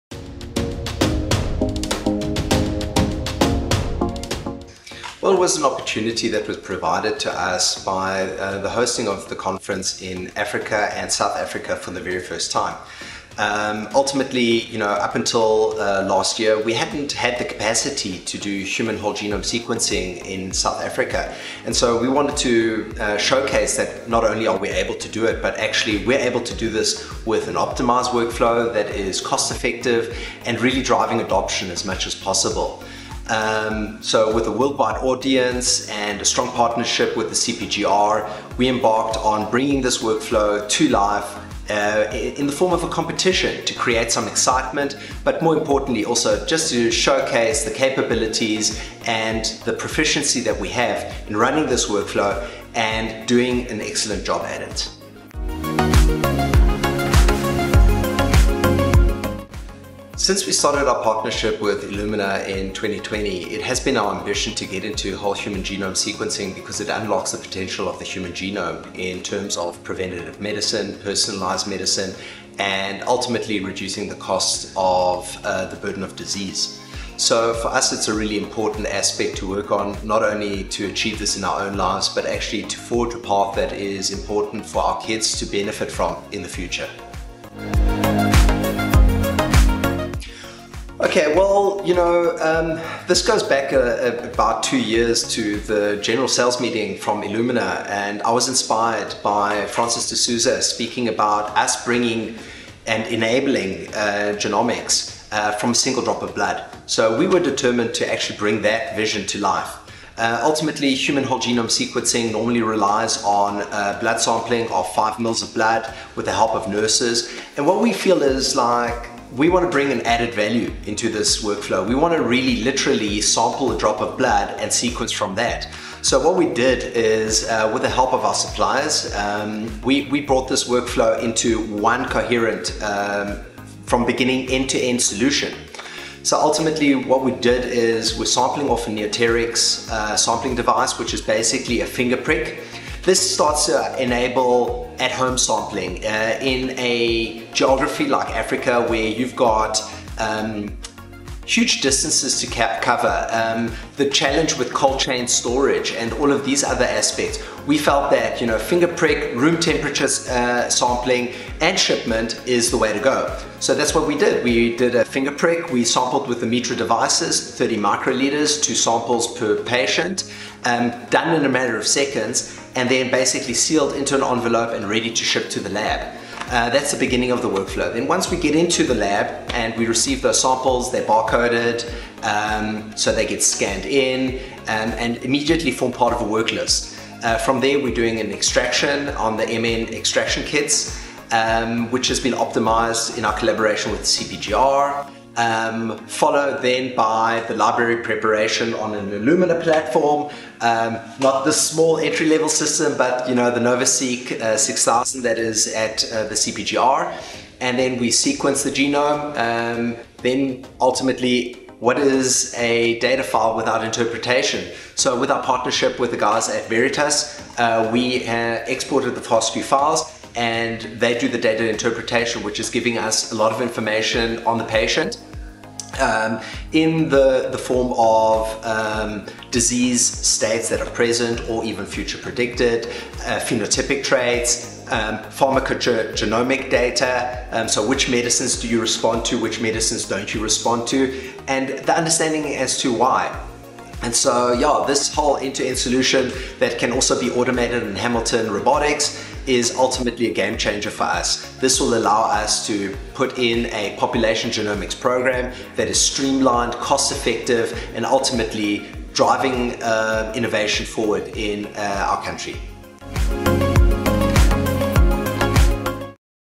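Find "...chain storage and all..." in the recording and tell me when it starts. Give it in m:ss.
2:34.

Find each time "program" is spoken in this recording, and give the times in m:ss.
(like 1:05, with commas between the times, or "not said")
4:14.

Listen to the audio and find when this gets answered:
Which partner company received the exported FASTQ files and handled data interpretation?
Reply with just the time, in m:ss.
3:36.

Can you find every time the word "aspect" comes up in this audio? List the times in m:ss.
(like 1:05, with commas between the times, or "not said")
1:18, 2:36.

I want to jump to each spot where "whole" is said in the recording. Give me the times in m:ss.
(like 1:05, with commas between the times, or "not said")
0:18, 1:05, 1:51, 4:05.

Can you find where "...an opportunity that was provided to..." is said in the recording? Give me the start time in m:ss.
0:05.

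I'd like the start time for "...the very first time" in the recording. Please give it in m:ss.
0:11.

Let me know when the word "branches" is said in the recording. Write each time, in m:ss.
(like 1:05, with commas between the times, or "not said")
not said.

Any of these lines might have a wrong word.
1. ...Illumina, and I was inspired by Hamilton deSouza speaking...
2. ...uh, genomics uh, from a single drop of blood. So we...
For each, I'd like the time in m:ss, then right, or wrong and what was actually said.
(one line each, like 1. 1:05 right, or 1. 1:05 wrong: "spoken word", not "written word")
1. 1:37 wrong: "Francis", not "Hamilton"
2. 1:43 right.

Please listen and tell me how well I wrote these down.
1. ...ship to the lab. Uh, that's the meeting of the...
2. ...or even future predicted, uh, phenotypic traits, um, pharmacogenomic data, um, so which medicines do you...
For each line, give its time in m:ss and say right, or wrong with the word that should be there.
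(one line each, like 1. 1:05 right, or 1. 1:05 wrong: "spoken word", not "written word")
1. 2:55 wrong: "beginning", not "meeting"
2. 3:51 right.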